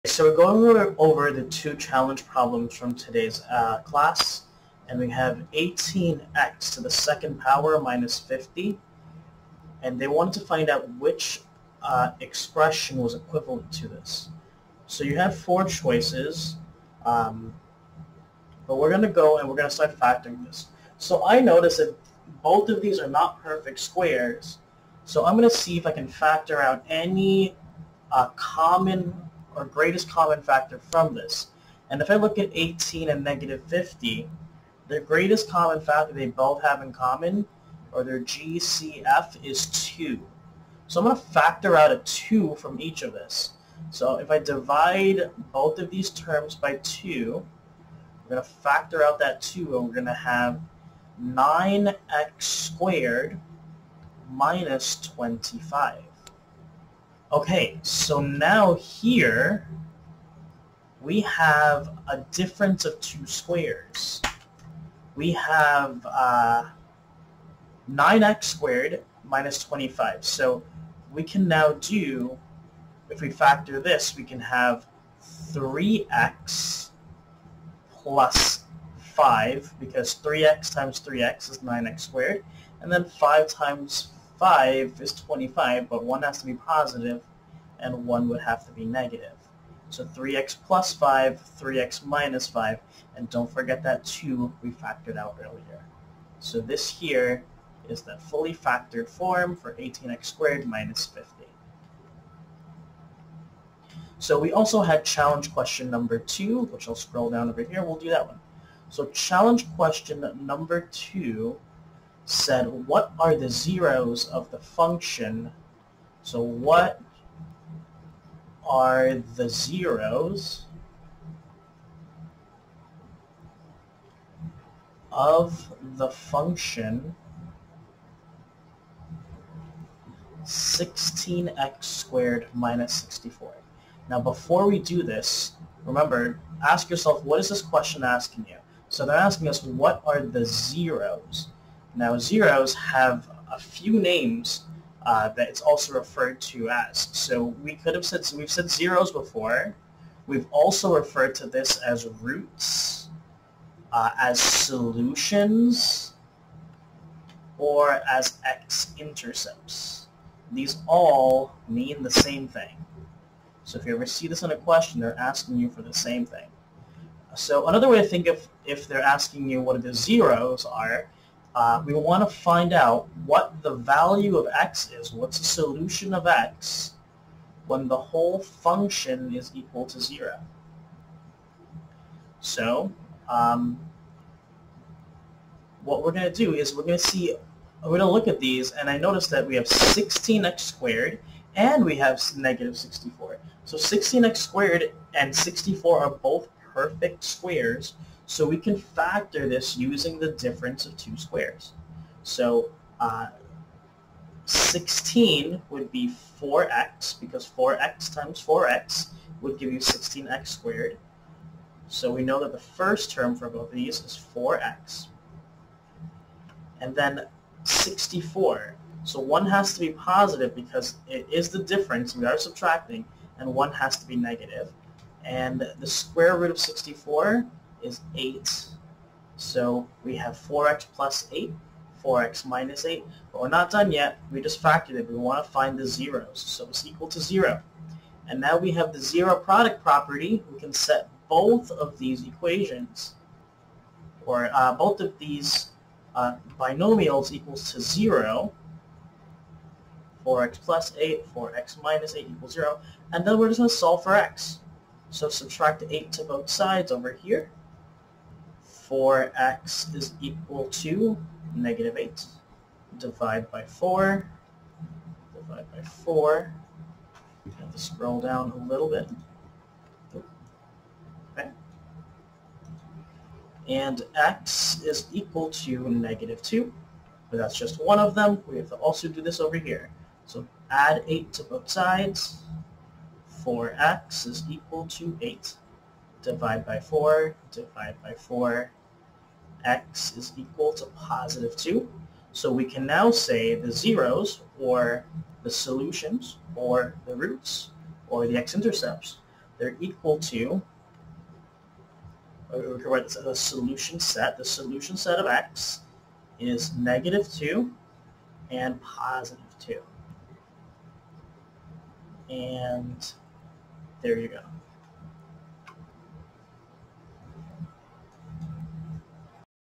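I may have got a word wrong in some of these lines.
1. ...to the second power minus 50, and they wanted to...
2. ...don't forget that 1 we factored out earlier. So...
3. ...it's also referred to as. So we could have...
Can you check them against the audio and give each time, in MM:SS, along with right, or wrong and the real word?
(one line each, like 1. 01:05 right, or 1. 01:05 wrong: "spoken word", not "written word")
1. 00:06 right
2. 01:33 wrong: "2", not "1"
3. 02:25 right.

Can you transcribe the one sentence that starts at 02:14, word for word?
Now before we do this, remember, ask yourself, what is this question asking you?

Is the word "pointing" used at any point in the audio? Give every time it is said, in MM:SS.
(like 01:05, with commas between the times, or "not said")
not said.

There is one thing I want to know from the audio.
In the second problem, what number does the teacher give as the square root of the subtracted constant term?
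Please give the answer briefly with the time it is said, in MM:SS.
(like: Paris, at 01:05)
8, at 03:45.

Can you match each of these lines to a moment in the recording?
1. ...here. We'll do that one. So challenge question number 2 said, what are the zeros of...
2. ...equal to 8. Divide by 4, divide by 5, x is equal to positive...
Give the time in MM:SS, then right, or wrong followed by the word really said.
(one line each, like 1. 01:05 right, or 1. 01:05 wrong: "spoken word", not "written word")
1. 01:47 right
2. 04:44 wrong: "4", not "5".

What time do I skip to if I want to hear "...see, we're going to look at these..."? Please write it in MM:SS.
03:07.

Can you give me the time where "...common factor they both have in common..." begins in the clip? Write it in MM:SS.
00:35.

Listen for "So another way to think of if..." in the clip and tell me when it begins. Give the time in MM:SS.
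02:47.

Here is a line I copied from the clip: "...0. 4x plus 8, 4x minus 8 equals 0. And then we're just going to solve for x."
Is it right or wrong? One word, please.
right.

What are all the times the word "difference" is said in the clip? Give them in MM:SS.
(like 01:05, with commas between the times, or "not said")
01:02, 03:20, 03:41.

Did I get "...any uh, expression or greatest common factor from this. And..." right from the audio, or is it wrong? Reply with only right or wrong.
wrong.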